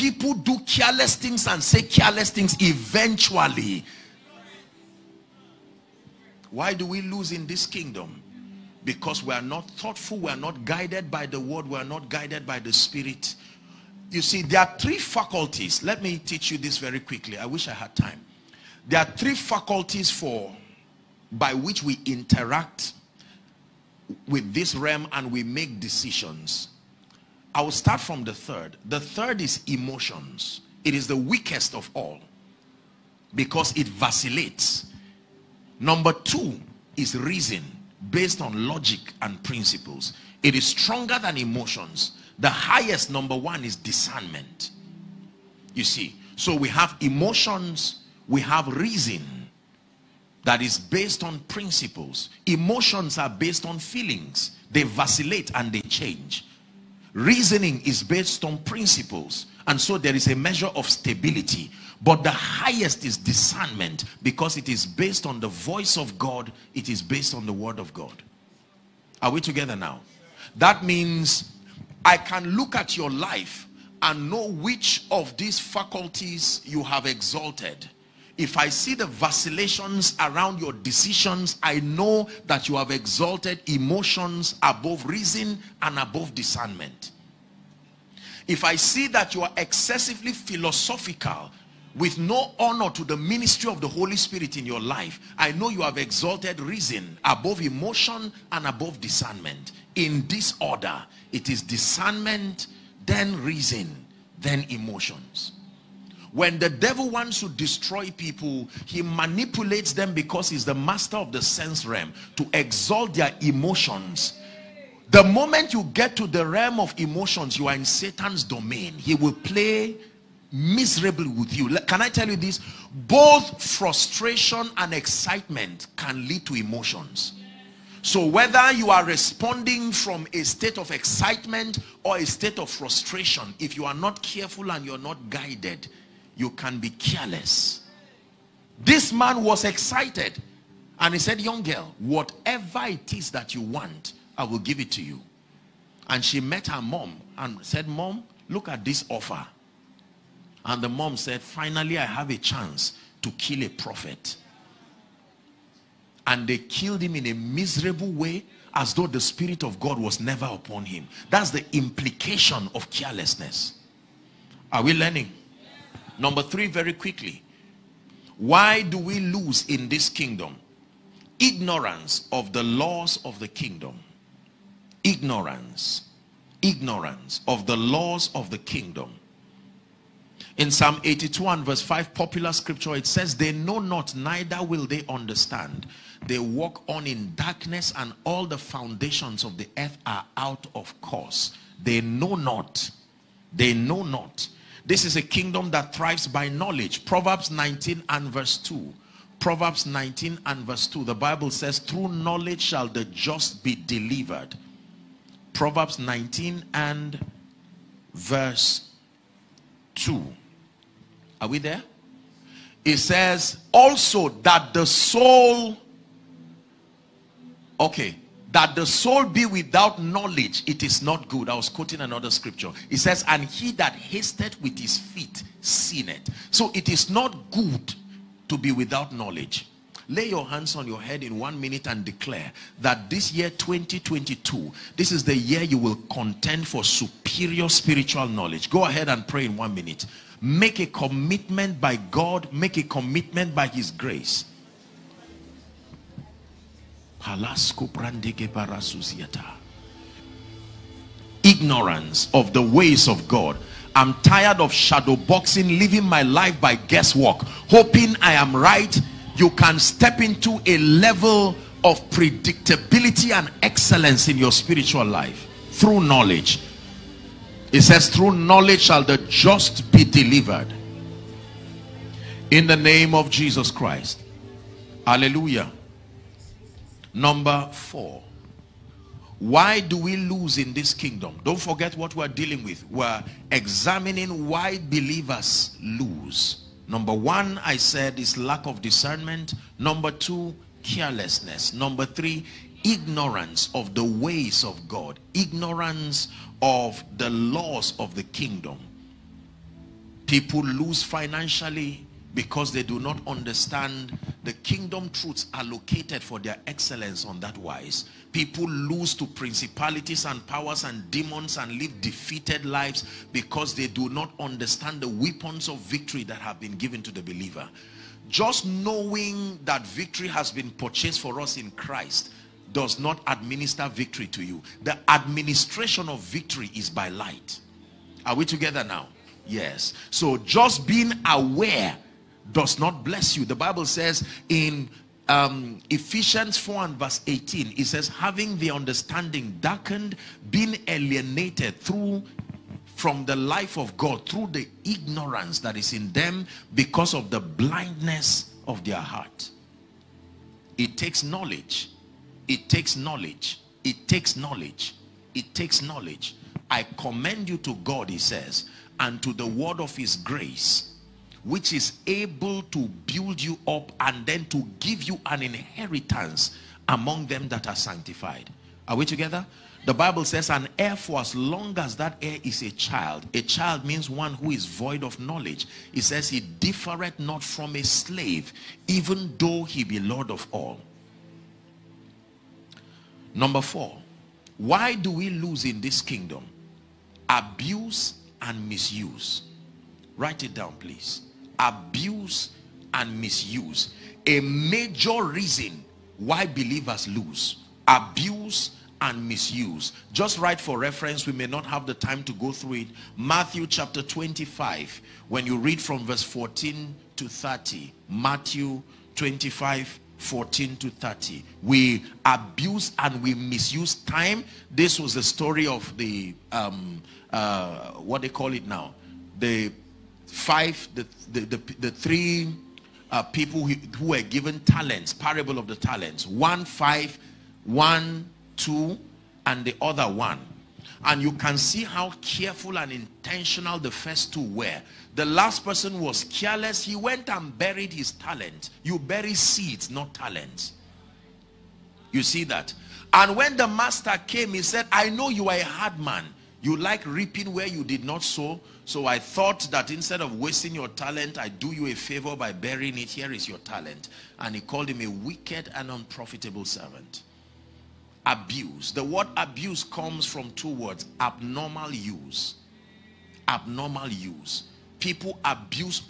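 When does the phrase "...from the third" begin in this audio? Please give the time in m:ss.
0:27.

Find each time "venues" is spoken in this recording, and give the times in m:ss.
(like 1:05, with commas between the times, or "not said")
not said.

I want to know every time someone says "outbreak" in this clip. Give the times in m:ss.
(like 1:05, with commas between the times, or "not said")
not said.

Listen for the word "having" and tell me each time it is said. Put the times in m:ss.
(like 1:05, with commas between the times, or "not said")
5:38.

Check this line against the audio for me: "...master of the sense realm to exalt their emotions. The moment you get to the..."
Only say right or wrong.
right.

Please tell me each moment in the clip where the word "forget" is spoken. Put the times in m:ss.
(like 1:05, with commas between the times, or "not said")
4:41.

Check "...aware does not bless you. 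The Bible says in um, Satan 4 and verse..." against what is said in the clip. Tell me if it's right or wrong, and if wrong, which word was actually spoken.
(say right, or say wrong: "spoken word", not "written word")
wrong: "Ephesians", not "Satan".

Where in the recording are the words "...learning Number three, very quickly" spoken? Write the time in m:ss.
2:44.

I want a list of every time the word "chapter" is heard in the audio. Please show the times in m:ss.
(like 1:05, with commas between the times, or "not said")
6:43.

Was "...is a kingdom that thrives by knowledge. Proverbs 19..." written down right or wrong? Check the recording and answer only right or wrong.
right.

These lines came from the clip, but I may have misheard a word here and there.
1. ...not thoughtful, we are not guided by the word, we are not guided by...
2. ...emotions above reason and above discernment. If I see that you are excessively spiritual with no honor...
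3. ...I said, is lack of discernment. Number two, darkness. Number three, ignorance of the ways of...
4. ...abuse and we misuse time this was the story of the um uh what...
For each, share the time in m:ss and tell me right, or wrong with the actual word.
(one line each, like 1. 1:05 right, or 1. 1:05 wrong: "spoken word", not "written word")
1. 0:09 right
2. 1:23 wrong: "philosophical", not "spiritual"
3. 4:47 wrong: "carelessness", not "darkness"
4. 6:52 right.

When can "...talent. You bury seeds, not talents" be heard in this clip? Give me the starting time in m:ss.
7:18.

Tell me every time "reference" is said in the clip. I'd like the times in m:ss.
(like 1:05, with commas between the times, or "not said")
6:40.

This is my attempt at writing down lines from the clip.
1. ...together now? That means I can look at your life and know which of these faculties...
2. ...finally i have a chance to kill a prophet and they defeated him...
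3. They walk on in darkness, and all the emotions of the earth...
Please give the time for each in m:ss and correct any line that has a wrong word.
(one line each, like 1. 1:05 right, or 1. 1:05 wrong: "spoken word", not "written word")
1. 1:09 right
2. 2:31 wrong: "killed", not "defeated"
3. 3:06 wrong: "foundations", not "emotions".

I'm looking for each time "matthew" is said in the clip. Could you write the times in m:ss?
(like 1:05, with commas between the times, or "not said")
6:43, 6:48.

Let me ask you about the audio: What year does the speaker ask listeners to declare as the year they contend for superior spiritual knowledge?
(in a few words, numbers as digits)
2022.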